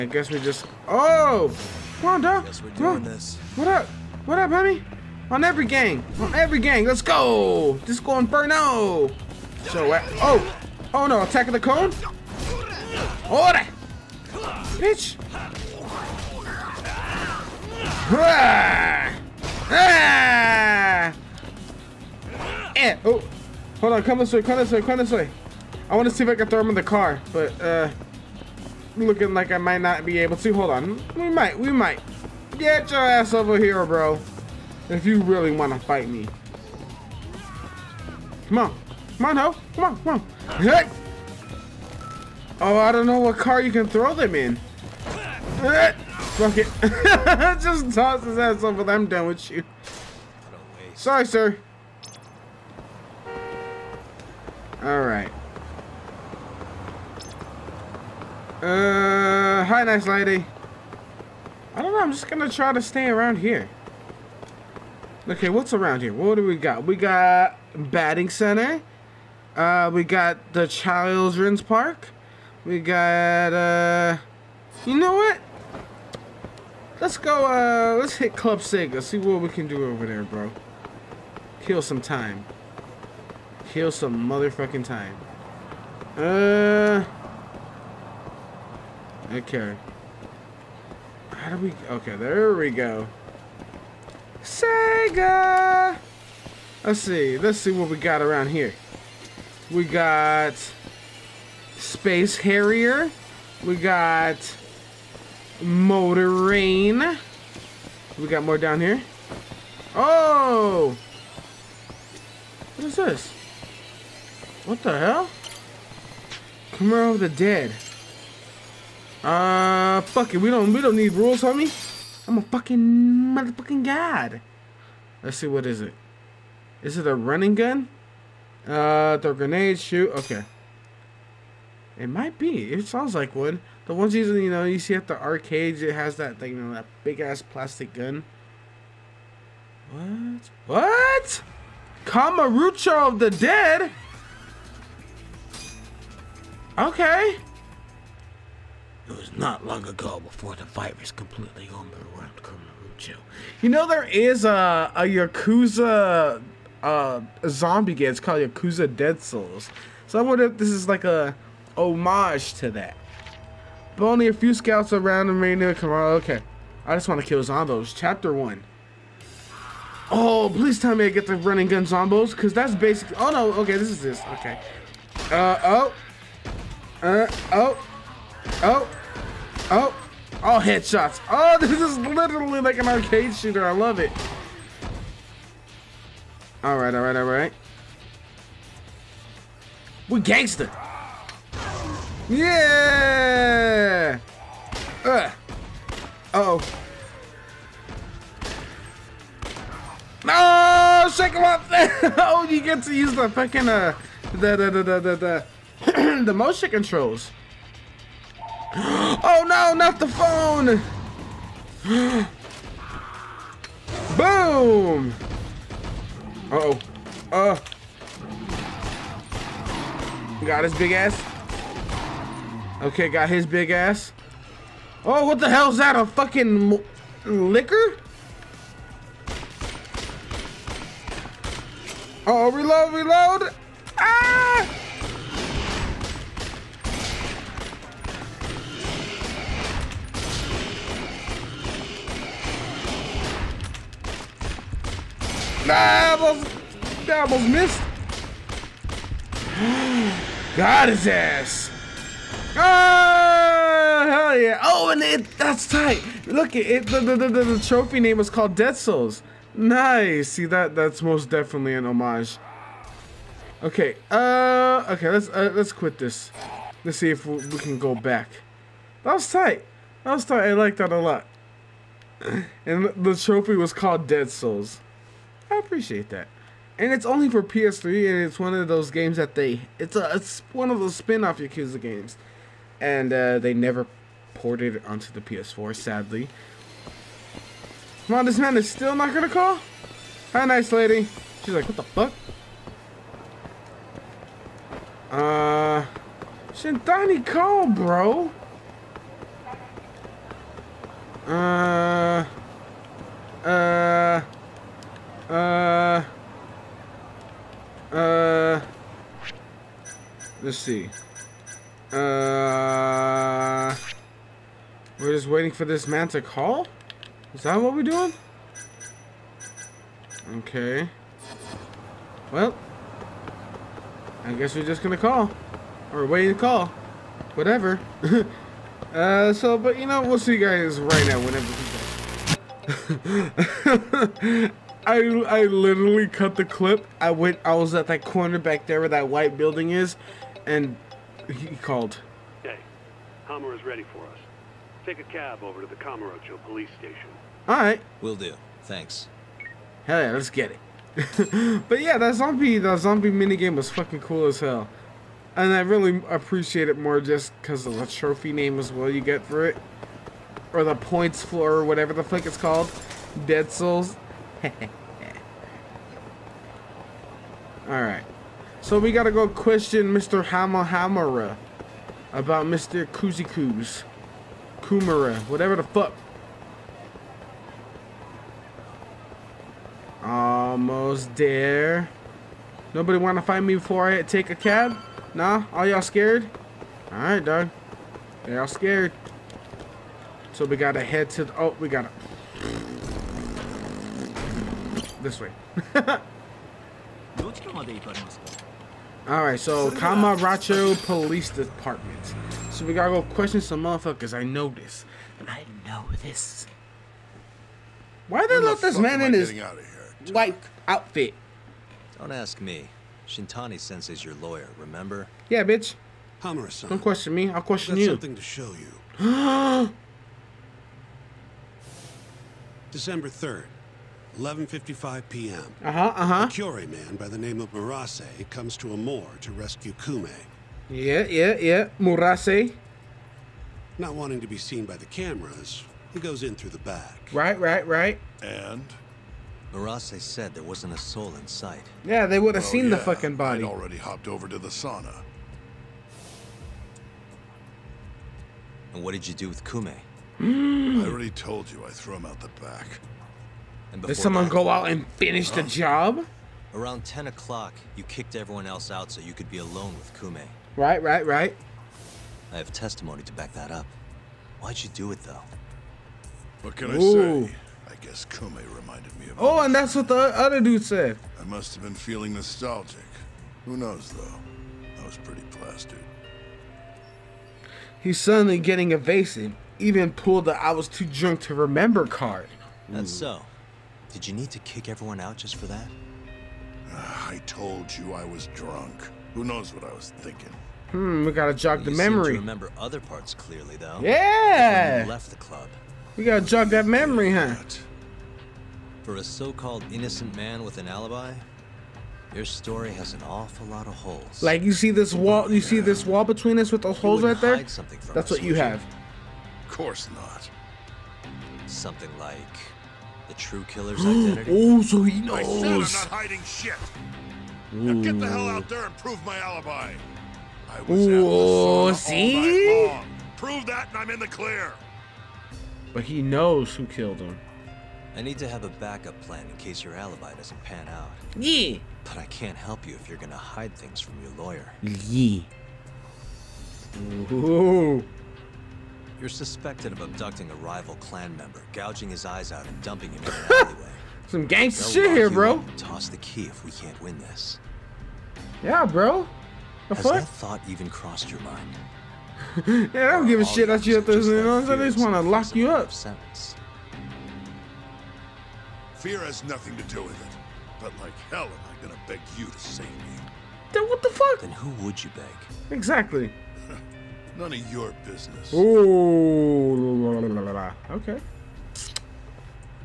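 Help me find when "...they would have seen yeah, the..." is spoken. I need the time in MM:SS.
07:22.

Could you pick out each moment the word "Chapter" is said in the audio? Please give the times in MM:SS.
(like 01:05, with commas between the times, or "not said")
02:47.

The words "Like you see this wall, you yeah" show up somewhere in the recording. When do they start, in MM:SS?
08:24.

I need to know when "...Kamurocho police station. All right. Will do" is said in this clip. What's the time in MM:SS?
05:45.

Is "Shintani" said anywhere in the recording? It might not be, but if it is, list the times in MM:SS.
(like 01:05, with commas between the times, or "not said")
04:56, 06:53.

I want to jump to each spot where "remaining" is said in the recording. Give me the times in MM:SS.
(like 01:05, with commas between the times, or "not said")
02:45.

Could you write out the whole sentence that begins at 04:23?
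Okay, uh, okay, let's, uh, let's quit this.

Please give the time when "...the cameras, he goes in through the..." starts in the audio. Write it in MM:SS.
07:14.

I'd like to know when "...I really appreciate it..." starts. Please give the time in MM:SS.
05:55.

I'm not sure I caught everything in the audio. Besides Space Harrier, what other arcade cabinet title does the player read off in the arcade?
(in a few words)
Motor Raid.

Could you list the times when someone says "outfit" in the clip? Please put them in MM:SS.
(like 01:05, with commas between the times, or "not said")
06:50.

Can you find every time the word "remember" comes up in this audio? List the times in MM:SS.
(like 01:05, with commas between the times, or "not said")
06:54, 08:01, 08:12.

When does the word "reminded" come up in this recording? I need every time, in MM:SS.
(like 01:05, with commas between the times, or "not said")
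07:48.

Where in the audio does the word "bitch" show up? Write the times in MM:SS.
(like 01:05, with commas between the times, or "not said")
00:14, 06:55.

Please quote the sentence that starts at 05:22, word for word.
Well, I guess we're just gonna call.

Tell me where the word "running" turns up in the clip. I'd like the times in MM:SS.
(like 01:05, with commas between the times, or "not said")
02:07, 02:51.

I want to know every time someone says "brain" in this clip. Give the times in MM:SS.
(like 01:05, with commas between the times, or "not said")
not said.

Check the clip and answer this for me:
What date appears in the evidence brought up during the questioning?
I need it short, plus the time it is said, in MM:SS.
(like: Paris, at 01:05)
December 3rd, at 07:02.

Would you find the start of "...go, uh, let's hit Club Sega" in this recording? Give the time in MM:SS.
01:17.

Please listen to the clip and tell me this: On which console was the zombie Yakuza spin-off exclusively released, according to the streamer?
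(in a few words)
PS3.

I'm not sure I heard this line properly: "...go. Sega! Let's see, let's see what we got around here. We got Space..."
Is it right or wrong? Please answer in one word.
right.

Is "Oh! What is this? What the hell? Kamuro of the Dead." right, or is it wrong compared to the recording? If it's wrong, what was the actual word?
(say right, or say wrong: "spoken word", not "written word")
right.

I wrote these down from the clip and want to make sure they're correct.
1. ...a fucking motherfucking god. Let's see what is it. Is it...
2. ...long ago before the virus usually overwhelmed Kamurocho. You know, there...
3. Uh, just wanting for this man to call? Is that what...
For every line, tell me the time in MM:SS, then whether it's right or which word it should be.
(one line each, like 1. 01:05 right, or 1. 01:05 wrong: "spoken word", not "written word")
1. 02:02 right
2. 02:29 wrong: "completely", not "usually"
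3. 05:11 wrong: "waiting", not "wanting".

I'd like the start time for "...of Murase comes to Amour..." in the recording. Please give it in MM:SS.
07:07.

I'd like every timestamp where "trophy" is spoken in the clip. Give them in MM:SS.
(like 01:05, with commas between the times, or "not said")
04:17, 04:33, 05:57.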